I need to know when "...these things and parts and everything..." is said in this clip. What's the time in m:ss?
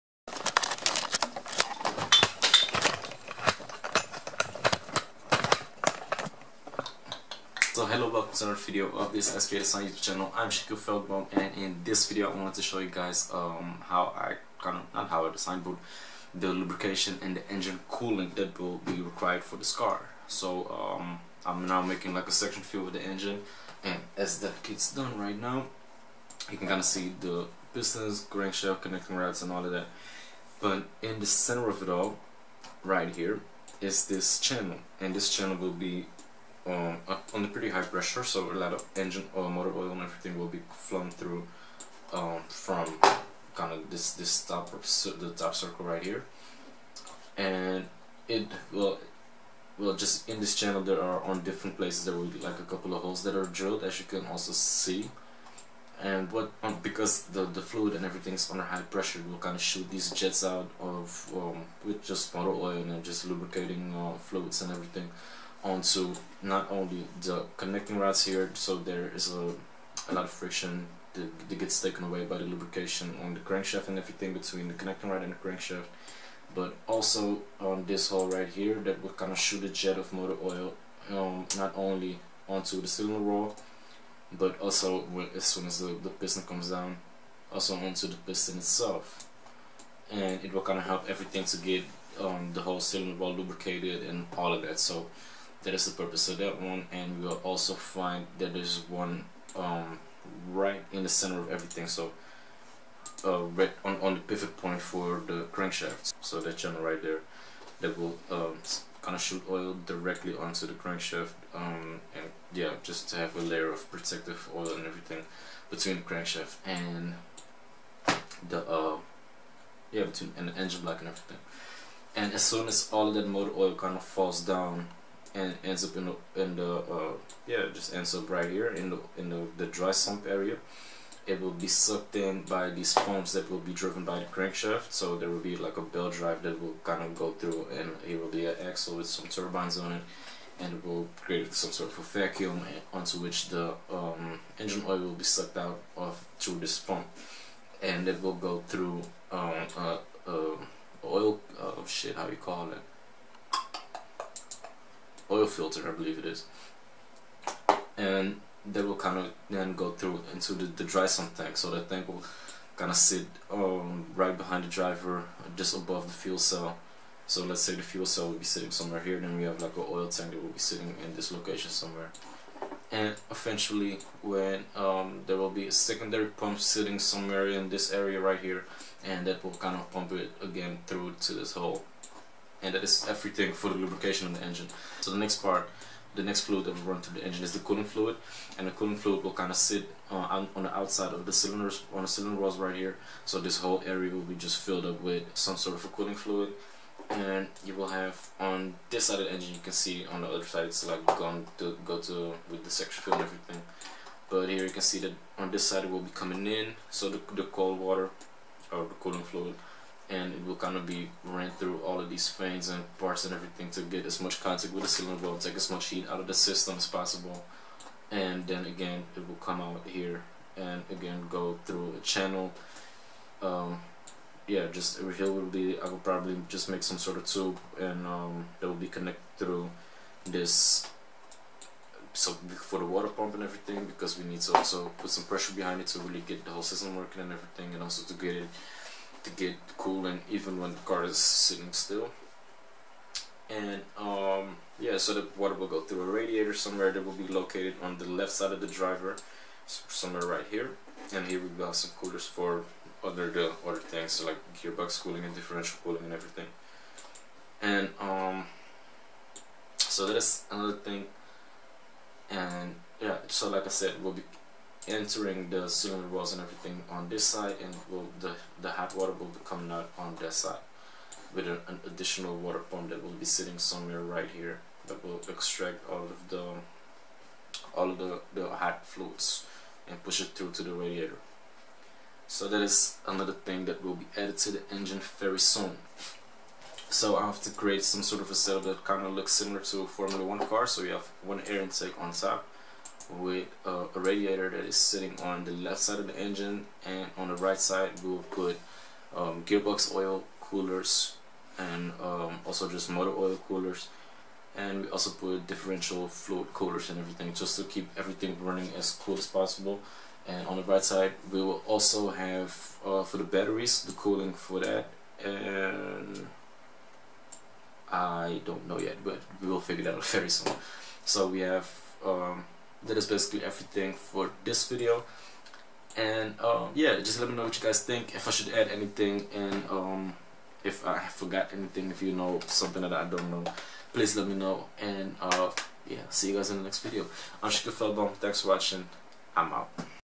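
3:32.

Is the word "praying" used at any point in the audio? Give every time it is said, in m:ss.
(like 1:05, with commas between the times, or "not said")
not said.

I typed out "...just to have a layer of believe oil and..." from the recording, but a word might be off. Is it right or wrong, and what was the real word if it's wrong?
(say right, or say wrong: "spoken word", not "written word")
wrong: "protective", not "believe".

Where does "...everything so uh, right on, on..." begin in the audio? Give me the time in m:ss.
1:41.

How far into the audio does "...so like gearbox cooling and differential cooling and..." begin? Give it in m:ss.
4:14.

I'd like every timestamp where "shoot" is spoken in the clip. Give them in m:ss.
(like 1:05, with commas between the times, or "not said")
0:59, 1:19, 1:49.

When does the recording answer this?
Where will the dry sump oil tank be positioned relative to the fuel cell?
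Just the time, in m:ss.
2:45.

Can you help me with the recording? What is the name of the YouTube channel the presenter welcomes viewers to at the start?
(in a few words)
SVA Design.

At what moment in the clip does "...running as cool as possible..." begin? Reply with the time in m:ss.
5:08.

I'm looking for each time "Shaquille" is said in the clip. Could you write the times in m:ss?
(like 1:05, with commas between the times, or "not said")
0:10, 5:37.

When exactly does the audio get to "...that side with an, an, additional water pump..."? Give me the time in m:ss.
4:30.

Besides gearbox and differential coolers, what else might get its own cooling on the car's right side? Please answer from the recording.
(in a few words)
Batteries.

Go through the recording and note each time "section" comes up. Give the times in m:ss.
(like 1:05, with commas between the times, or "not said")
0:22, 3:22.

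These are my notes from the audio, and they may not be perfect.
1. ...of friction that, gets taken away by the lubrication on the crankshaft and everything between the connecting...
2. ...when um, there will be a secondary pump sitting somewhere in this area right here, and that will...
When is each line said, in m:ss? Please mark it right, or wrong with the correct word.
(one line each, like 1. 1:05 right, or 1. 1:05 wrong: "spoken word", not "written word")
1. 1:10 right
2. 2:54 right.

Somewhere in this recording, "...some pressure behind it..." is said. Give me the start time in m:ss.
3:55.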